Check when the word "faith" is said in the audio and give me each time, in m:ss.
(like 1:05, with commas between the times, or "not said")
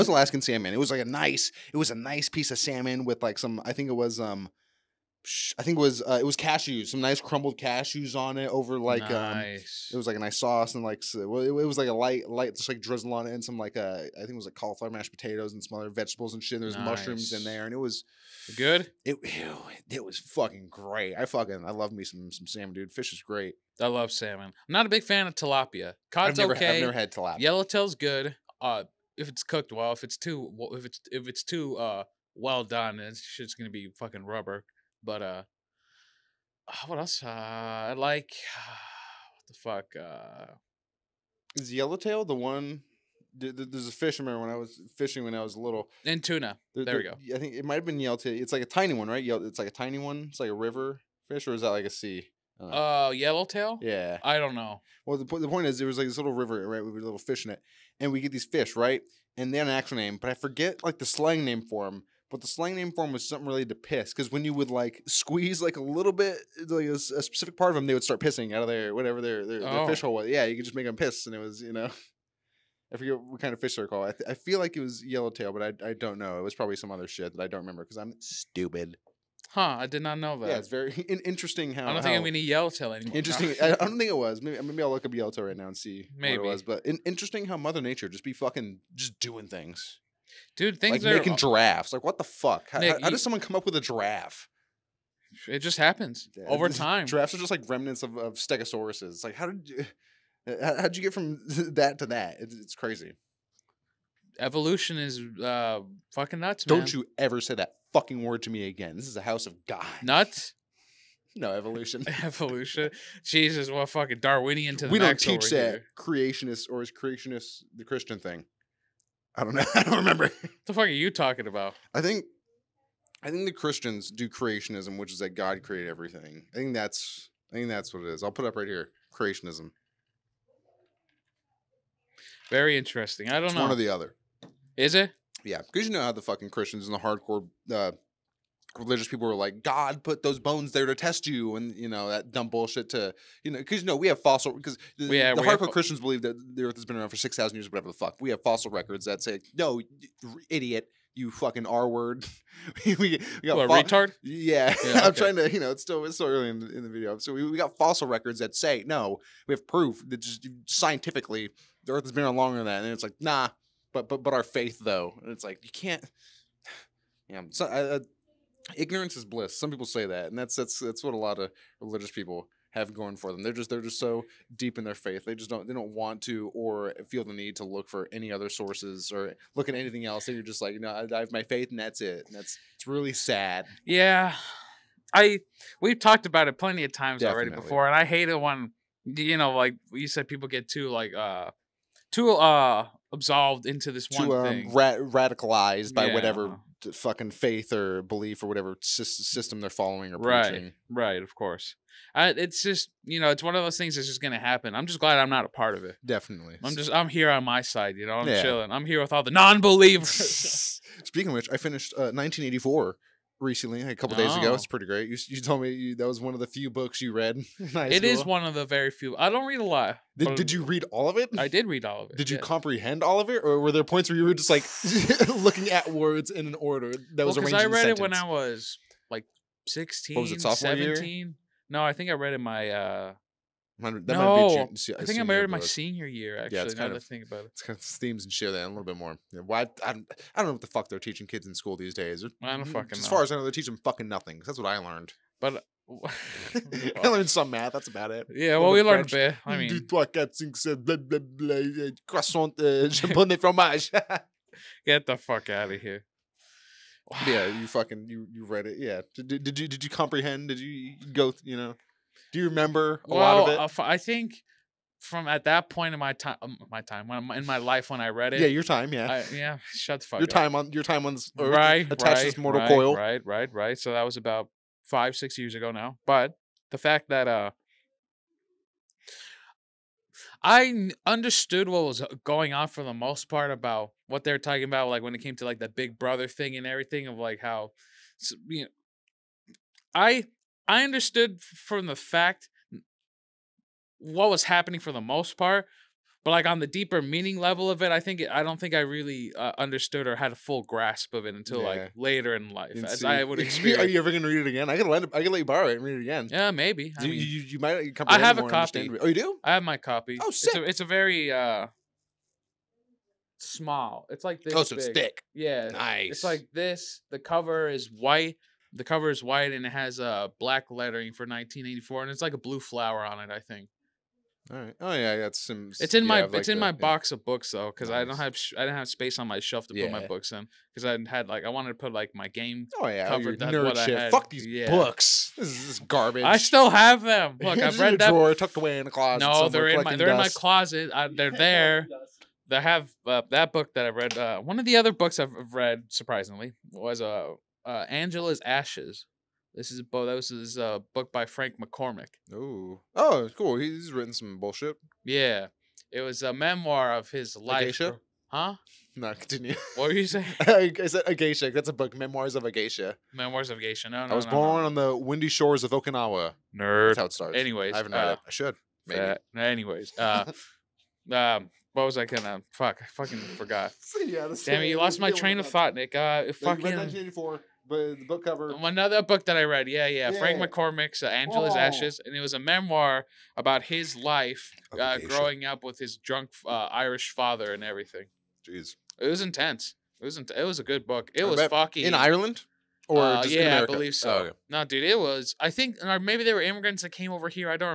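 2:44, 2:54, 3:01, 3:17.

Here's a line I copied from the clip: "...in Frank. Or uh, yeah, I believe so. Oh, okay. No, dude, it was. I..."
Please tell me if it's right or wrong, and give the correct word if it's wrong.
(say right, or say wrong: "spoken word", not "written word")
wrong: "Ireland", not "Frank".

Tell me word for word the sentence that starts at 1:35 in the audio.
It just happens yeah, over time.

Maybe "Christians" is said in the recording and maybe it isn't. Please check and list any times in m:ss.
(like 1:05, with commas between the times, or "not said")
1:57, 2:03, 2:16, 2:25.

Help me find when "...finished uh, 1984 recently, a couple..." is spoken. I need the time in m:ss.
3:31.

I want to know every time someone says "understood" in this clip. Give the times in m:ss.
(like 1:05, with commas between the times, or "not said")
4:41, 4:50, 4:59.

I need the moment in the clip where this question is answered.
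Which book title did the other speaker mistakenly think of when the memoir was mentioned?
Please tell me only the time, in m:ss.
6:01.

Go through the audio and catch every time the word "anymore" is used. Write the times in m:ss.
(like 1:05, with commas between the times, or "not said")
1:22.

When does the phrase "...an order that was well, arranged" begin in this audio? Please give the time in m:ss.
3:46.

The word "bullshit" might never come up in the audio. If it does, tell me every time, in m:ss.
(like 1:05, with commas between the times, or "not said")
2:22, 5:54.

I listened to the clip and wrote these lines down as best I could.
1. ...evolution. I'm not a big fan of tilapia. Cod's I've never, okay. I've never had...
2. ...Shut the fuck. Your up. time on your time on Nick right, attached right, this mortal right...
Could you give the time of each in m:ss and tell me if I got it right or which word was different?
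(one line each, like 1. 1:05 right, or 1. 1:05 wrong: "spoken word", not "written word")
1. 0:24 wrong: "salmon", not "evolution"
2. 4:29 wrong: "Earth", not "Nick".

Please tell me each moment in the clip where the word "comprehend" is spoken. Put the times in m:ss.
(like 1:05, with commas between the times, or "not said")
3:42, 4:19.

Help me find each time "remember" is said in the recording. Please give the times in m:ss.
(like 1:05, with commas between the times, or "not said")
0:44, 1:17, 1:59, 4:22.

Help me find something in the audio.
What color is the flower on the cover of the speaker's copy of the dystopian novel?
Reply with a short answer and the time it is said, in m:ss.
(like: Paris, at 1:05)
blue, at 5:22.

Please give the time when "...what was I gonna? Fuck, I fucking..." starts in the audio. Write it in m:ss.
6:11.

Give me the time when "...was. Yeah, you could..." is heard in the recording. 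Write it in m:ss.
1:10.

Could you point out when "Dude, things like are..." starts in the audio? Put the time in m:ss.
1:30.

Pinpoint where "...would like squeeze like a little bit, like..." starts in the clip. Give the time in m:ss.
1:04.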